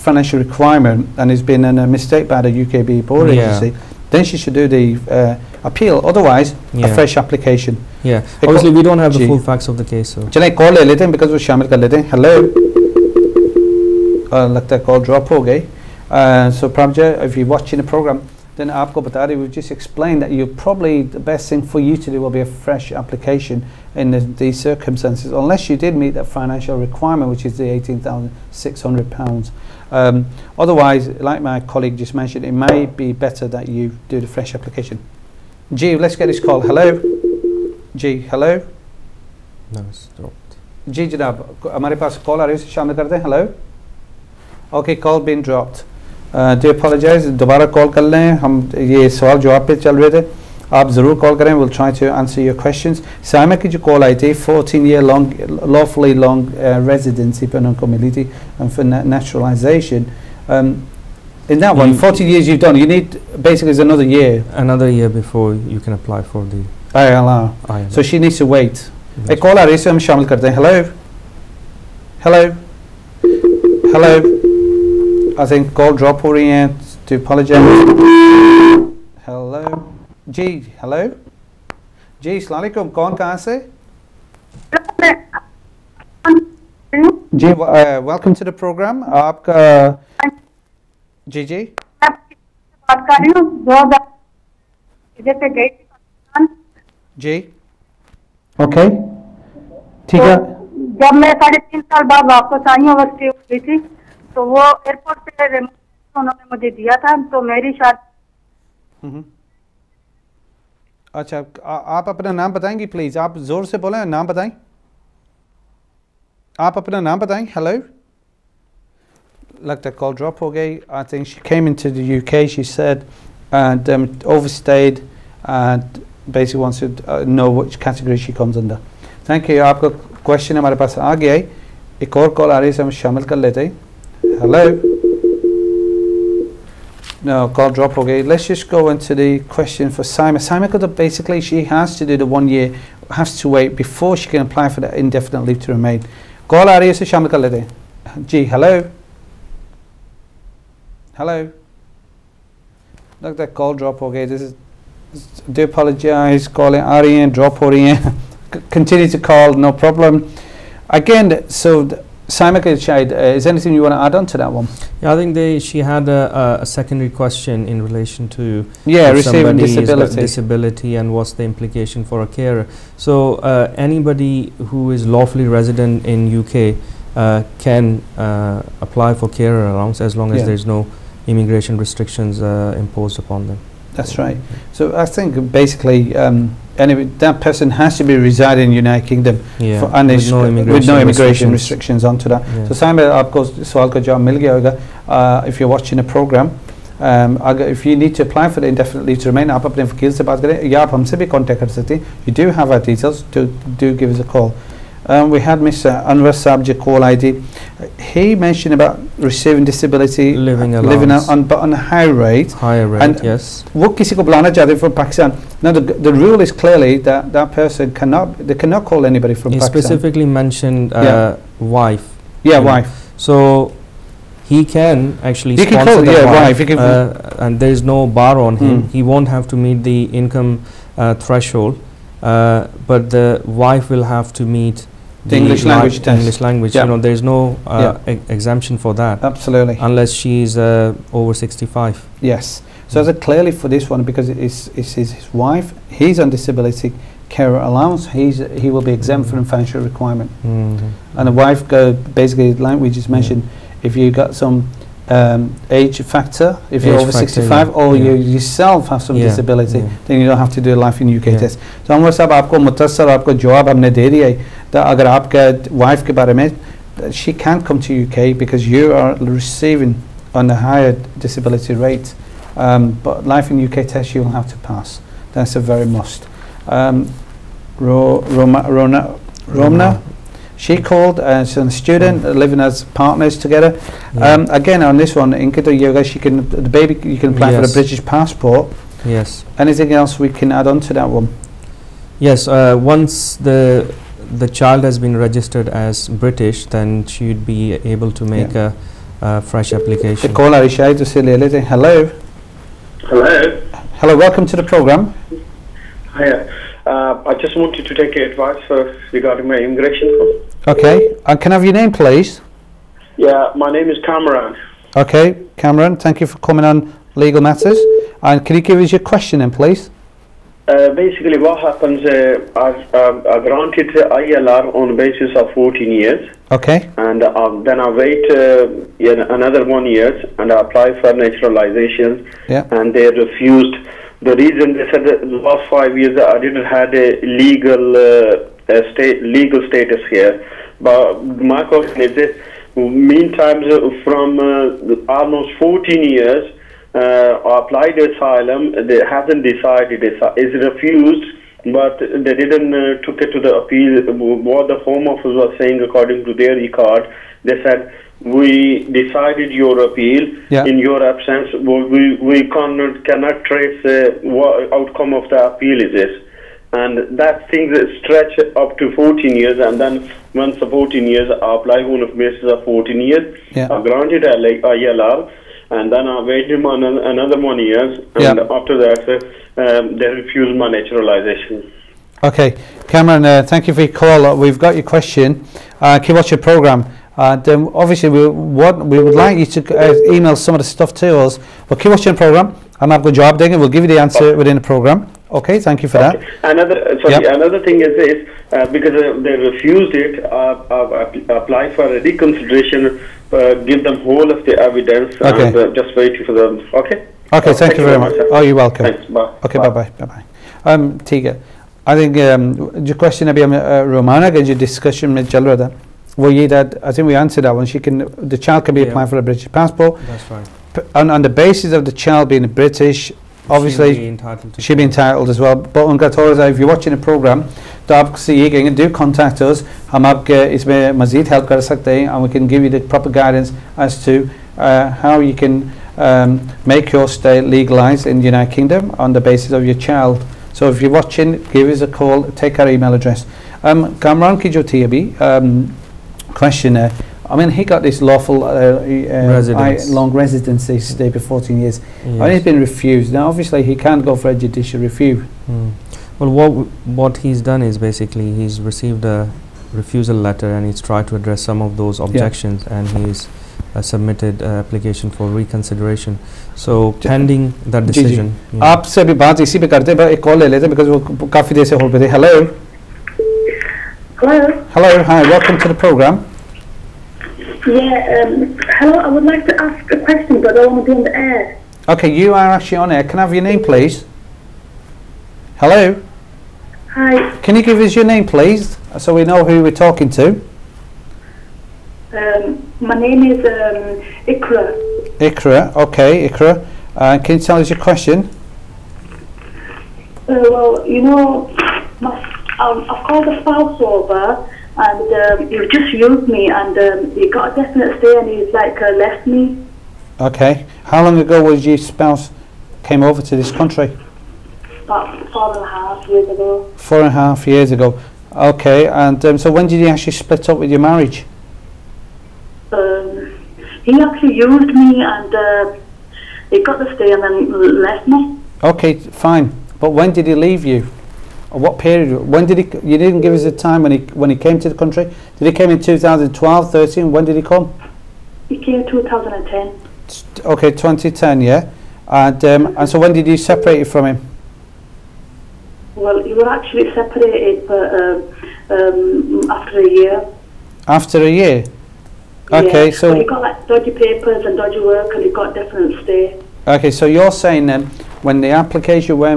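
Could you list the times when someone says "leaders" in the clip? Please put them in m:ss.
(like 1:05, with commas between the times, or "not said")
not said.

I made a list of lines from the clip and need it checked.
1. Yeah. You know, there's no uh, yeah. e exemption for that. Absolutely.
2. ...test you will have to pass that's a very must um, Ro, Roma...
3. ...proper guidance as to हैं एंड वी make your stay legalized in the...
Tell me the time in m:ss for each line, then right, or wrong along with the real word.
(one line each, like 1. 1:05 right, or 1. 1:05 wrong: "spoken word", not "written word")
1. 3:56 right
2. 4:33 right
3. 7:12 right.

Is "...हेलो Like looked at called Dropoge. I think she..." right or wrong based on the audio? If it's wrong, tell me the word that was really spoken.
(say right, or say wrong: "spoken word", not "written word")
right.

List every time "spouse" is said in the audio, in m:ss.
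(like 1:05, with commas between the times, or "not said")
8:23, 8:31.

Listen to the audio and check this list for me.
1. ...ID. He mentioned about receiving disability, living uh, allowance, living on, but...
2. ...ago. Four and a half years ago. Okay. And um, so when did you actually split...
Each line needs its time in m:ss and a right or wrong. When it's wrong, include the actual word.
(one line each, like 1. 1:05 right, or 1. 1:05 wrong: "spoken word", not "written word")
1. 3:27 right
2. 8:36 right.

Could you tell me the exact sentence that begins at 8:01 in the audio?
Okay, you are actually on air.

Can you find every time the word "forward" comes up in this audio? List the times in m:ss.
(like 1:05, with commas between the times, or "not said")
not said.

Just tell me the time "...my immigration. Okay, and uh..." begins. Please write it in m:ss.
5:09.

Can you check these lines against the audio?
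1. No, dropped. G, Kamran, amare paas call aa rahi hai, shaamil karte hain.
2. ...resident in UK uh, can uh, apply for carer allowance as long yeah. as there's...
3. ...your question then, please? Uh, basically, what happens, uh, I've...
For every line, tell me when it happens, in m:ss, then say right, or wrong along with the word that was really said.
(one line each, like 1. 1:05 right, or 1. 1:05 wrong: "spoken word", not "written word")
1. 0:39 wrong: "Janab", not "Kamran"
2. 2:55 right
3. 5:18 right.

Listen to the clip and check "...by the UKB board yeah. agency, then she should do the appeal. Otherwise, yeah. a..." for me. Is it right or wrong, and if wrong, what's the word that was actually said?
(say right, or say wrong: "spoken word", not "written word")
right.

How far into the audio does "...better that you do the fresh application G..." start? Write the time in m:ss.
0:33.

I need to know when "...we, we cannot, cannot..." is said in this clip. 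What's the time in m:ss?
6:01.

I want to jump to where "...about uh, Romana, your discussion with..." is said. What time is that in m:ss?
6:53.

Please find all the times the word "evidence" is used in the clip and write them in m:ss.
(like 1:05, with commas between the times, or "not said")
6:44.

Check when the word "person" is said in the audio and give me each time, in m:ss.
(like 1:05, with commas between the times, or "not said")
3:07, 3:37.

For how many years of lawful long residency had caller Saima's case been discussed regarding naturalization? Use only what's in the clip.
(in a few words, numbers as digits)
14.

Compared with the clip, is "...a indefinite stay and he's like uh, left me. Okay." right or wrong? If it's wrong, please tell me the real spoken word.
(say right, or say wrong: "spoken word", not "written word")
wrong: "definite", not "indefinite".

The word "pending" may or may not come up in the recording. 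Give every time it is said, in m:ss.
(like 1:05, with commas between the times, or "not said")
7:47.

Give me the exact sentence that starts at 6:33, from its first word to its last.
We'll give you the answer within the program.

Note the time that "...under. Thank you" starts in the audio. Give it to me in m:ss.
2:08.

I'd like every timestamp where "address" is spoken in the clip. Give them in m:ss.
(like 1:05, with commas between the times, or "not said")
7:22, 7:41.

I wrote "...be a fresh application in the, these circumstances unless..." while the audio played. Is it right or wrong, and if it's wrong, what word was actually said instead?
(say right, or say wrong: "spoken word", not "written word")
right.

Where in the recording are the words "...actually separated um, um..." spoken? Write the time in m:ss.
9:06.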